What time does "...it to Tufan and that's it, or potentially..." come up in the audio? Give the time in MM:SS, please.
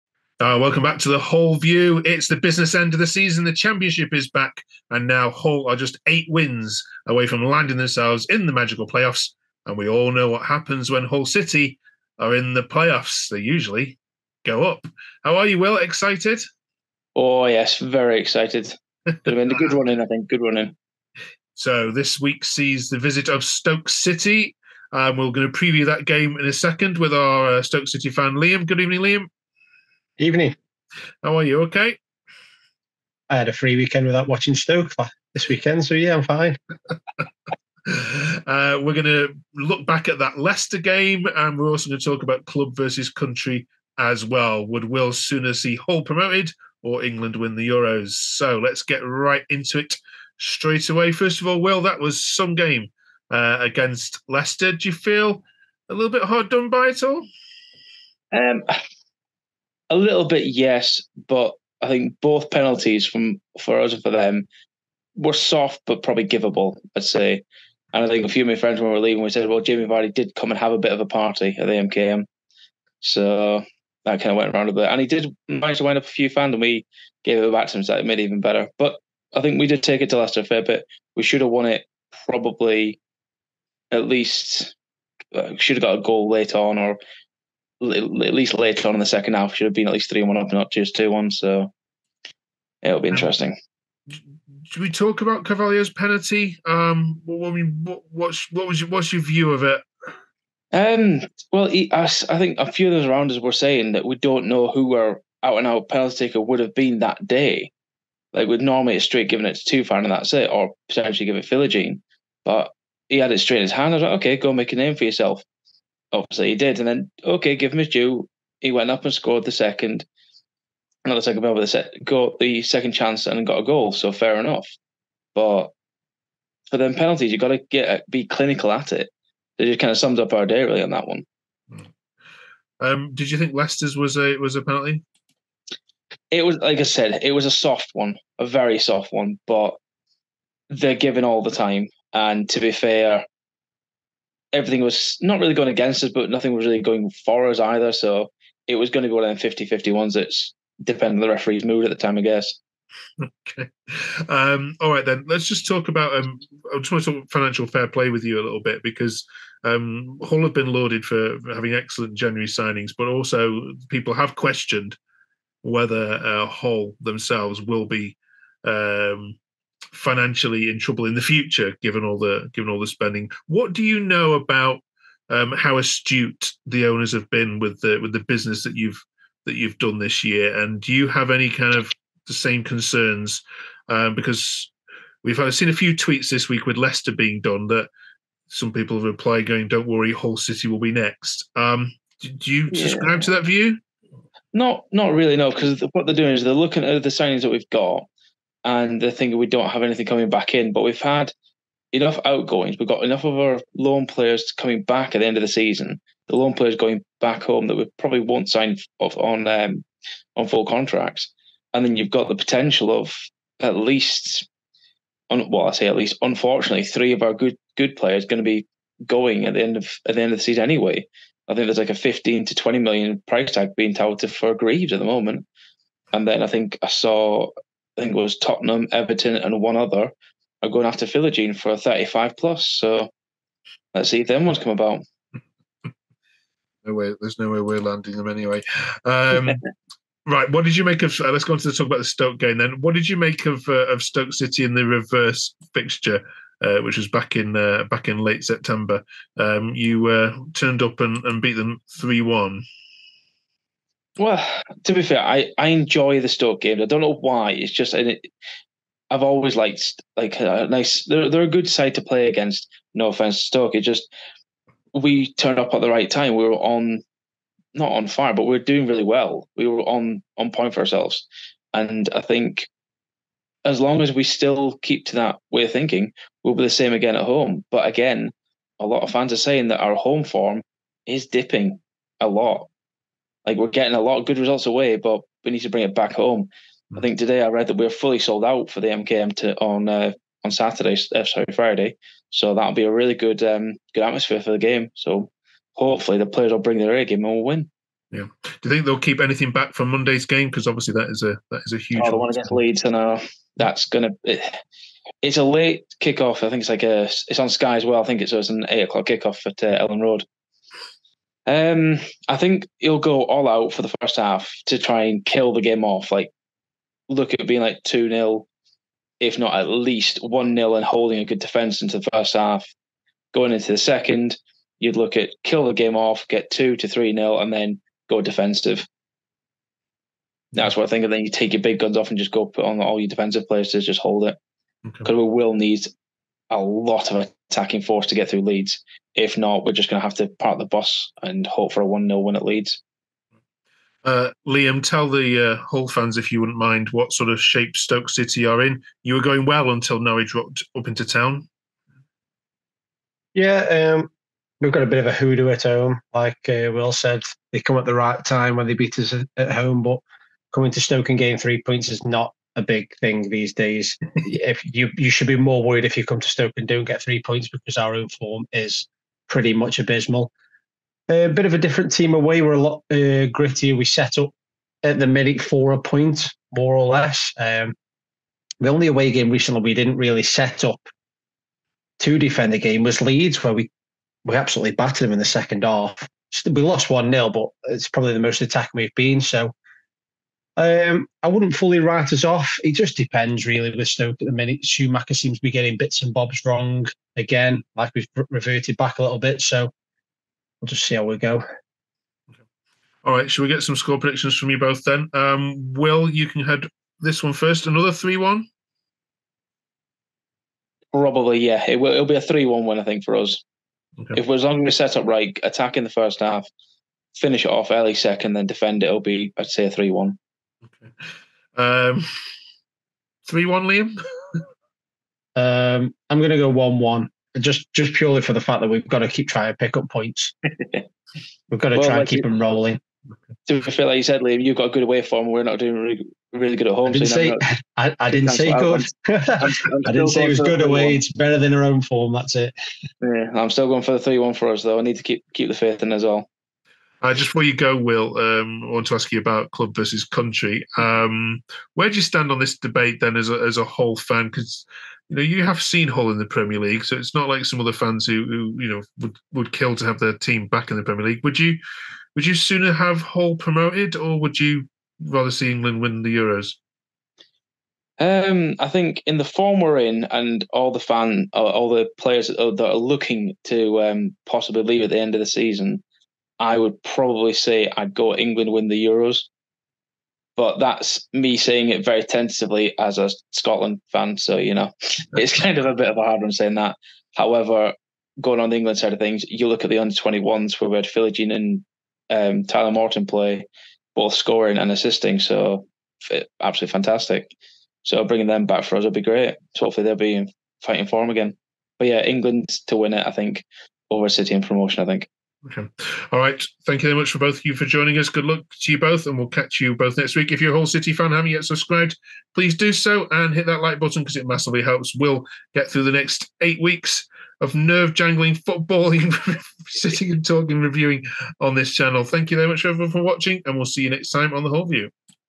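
01:49.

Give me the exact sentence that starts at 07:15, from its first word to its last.
We're not doing really, really good at home.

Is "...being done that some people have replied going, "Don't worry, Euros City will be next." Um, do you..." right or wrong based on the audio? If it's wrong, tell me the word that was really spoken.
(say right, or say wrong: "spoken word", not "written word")
wrong: "Hull", not "Euros".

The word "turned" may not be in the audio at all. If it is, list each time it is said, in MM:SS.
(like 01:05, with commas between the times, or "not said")
04:10, 04:25.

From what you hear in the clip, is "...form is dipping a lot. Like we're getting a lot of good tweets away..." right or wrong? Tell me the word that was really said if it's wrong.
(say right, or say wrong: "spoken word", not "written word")
wrong: "results", not "tweets".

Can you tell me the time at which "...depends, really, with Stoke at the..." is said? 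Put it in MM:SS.
06:32.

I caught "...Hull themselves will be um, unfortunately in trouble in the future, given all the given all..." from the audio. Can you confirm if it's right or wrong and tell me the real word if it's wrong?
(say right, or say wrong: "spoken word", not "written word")
wrong: "financially", not "unfortunately".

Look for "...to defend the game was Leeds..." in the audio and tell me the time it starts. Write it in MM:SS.
06:21.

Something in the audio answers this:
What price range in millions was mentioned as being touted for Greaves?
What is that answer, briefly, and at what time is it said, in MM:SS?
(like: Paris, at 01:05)
15 to 20 million, at 03:41.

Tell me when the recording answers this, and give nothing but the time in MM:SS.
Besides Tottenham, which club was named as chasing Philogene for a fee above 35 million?
03:48.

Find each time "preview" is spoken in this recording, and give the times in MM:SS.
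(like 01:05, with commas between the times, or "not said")
00:25.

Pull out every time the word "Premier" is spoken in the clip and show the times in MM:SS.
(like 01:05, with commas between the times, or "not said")
07:36, 07:40.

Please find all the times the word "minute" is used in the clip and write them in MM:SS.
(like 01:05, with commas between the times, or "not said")
06:15, 06:34.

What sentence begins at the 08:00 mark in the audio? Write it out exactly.
But that's me saying it very tentatively as a Scotland fan.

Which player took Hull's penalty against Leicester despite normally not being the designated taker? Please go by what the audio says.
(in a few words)
Carvalho.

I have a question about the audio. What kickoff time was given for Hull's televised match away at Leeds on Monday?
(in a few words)
8 o'clock.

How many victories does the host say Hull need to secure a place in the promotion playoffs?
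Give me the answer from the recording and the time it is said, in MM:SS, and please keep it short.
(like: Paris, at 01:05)
8, at 00:06.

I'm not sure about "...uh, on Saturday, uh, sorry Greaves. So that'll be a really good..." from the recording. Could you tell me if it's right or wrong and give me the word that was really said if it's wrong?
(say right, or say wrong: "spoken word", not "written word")
wrong: "Friday", not "Greaves".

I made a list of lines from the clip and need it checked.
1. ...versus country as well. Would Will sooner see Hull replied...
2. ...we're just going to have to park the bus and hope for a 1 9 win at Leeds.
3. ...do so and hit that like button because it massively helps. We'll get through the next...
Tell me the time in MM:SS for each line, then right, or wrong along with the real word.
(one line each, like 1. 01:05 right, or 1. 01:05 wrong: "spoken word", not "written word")
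1. 00:42 wrong: "promoted", not "replied"
2. 05:39 wrong: "0", not "9"
3. 08:32 right.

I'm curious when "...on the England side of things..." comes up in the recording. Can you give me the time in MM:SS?
08:08.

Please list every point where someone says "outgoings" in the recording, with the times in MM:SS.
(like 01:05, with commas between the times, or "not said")
03:22.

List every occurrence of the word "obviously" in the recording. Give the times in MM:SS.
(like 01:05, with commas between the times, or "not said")
01:56, 05:00.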